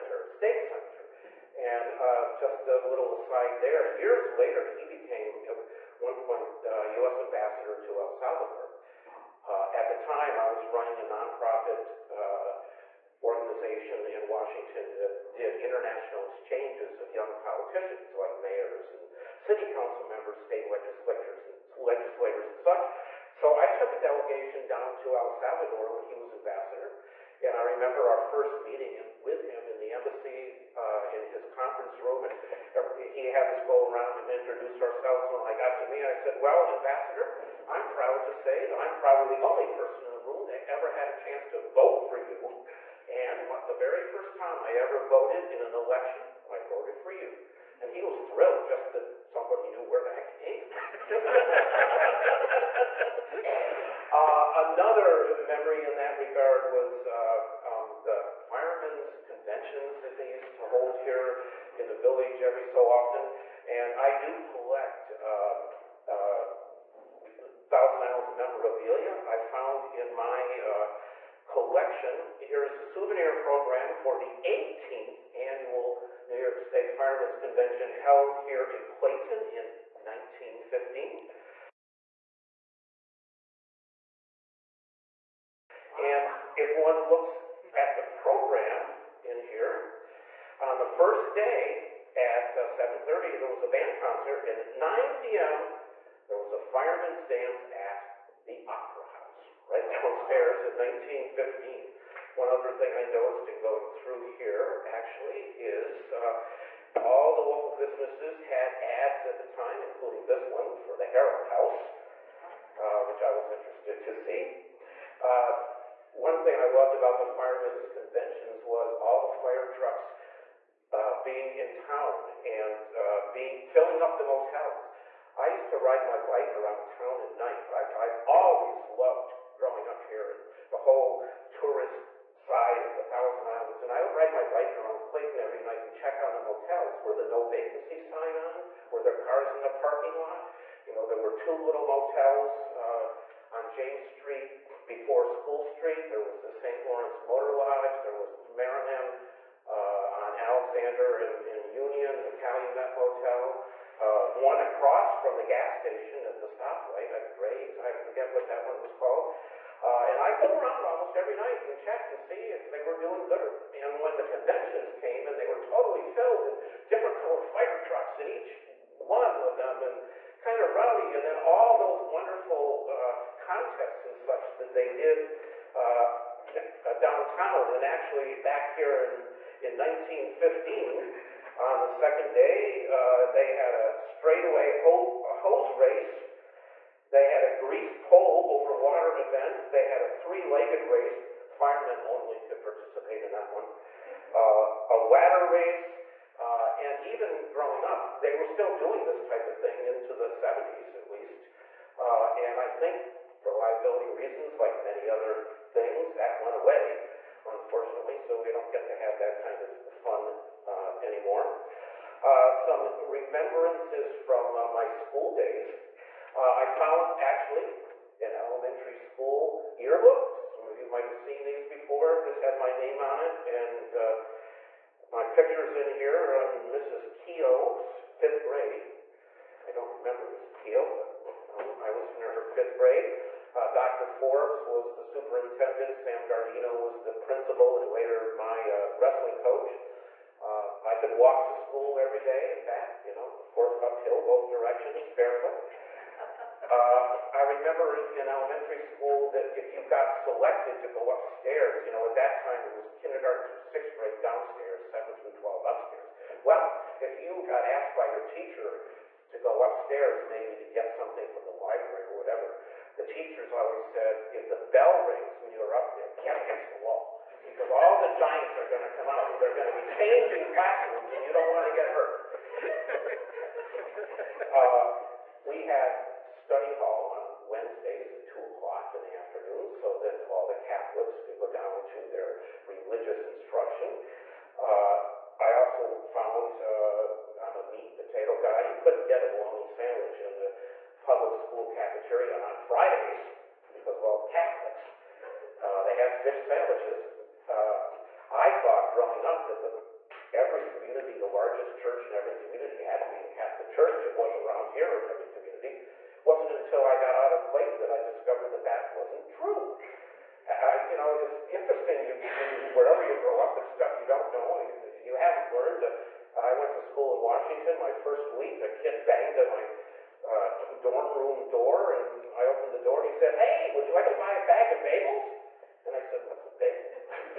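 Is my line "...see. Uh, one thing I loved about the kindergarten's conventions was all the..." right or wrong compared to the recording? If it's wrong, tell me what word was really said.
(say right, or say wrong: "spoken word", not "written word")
wrong: "firemen", not "kindergarten".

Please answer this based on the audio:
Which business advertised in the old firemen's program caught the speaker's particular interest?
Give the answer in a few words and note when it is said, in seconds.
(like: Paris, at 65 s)
Harold House, at 111 s.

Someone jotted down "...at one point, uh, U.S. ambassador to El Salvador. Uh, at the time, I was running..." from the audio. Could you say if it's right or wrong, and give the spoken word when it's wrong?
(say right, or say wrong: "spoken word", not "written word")
right.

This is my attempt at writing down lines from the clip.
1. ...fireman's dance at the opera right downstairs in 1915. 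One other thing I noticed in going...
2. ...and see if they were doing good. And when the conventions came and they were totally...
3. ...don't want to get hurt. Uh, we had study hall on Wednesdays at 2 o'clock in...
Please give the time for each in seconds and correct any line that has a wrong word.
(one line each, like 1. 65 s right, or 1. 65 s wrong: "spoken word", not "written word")
1. 96 s right
2. 162 s right
3. 271 s right.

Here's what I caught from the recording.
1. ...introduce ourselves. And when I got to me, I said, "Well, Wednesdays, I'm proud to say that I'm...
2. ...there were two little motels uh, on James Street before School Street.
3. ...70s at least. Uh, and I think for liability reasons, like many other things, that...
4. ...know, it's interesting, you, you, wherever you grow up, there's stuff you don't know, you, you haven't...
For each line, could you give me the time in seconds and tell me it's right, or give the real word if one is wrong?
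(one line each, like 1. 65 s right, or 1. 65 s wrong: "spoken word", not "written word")
1. 34 s wrong: "Ambassador", not "Wednesdays"
2. 141 s right
3. 200 s right
4. 310 s right.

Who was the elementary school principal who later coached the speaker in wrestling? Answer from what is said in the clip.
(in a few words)
Sam Gardino.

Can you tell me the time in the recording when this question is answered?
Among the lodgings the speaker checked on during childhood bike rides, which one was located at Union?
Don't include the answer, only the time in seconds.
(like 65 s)
152 s.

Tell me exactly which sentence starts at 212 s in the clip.
Uh, some remembrances from uh, my school days.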